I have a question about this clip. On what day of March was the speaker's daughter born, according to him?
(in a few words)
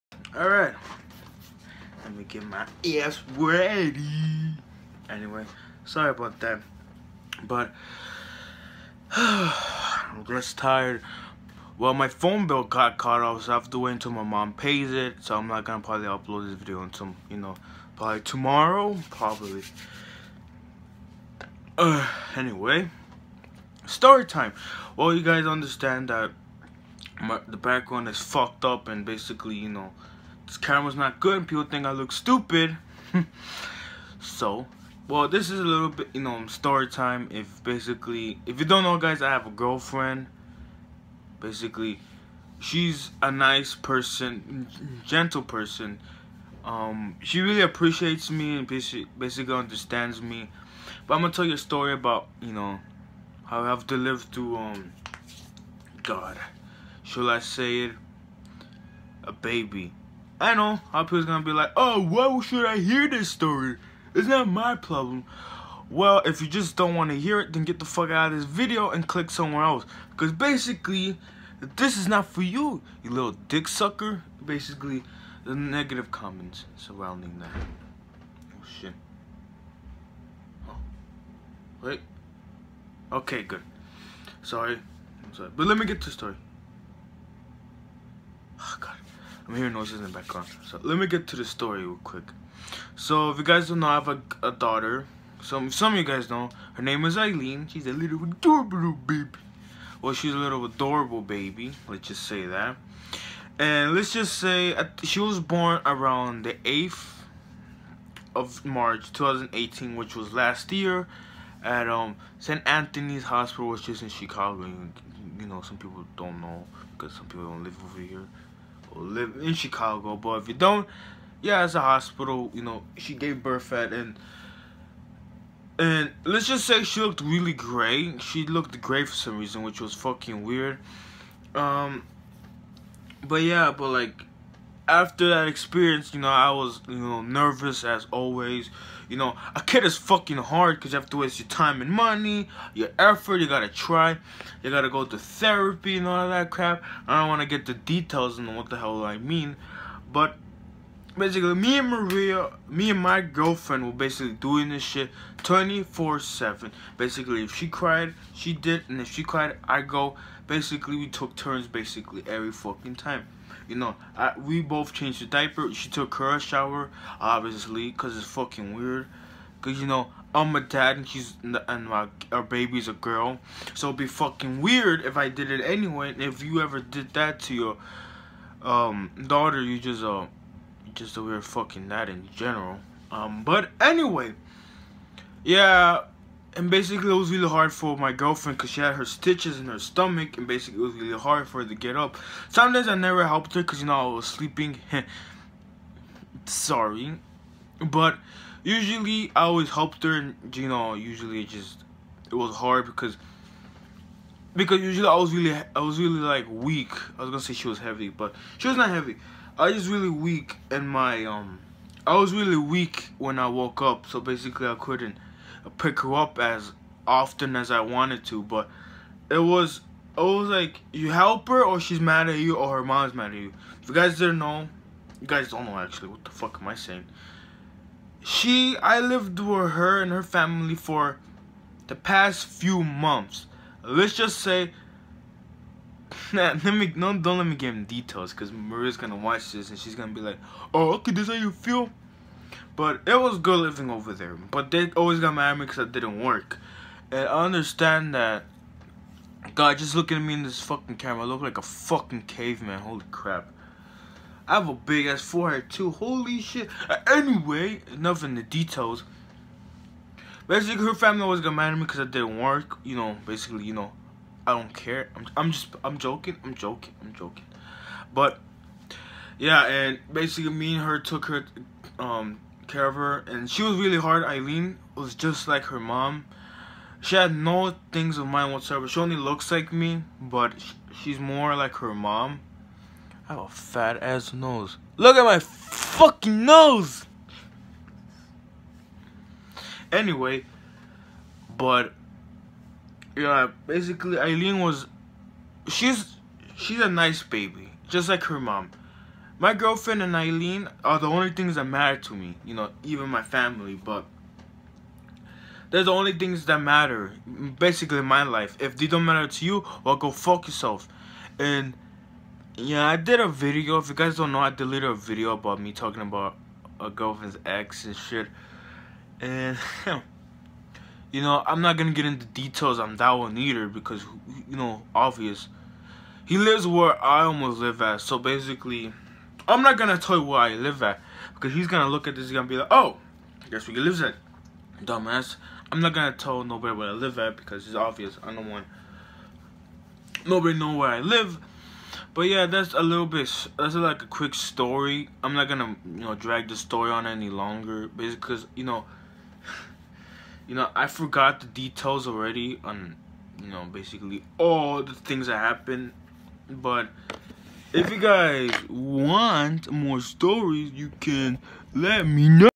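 8th.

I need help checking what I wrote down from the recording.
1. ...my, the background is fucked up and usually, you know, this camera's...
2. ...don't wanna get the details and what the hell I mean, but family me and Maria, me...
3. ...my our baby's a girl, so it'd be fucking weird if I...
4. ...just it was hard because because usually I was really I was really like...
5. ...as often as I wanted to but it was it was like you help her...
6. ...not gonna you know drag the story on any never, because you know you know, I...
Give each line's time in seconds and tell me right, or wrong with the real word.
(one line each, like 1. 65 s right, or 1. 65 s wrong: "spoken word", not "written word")
1. 27 s wrong: "basically", not "usually"
2. 147 s wrong: "basically", not "family"
3. 171 s right
4. 201 s right
5. 216 s right
6. 345 s wrong: "longer", not "never".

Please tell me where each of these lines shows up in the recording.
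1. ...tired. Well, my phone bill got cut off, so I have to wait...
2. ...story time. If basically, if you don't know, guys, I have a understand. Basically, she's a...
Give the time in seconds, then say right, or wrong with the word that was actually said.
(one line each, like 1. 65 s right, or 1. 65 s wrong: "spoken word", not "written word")
1. 10 s right
2. 36 s wrong: "girlfriend", not "understand".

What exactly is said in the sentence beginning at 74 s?
Basically, the negative comments surrounding that.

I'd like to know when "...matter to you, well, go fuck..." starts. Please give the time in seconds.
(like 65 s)
309 s.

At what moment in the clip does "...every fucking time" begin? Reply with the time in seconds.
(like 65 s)
162 s.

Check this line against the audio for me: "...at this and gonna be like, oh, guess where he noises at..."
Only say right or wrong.
wrong.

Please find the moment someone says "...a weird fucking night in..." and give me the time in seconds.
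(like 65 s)
181 s.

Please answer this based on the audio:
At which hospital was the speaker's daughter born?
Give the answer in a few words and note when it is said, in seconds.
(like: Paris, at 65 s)
St. Anthony's Hospital, at 112 s.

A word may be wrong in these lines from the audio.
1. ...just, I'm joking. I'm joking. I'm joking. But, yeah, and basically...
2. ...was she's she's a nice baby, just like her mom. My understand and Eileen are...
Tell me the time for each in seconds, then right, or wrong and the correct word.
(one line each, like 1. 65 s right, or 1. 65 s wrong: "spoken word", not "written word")
1. 265 s right
2. 294 s wrong: "girlfriend", not "understand".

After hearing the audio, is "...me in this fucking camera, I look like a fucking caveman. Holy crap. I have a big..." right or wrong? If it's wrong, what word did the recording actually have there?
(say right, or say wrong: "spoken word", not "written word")
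right.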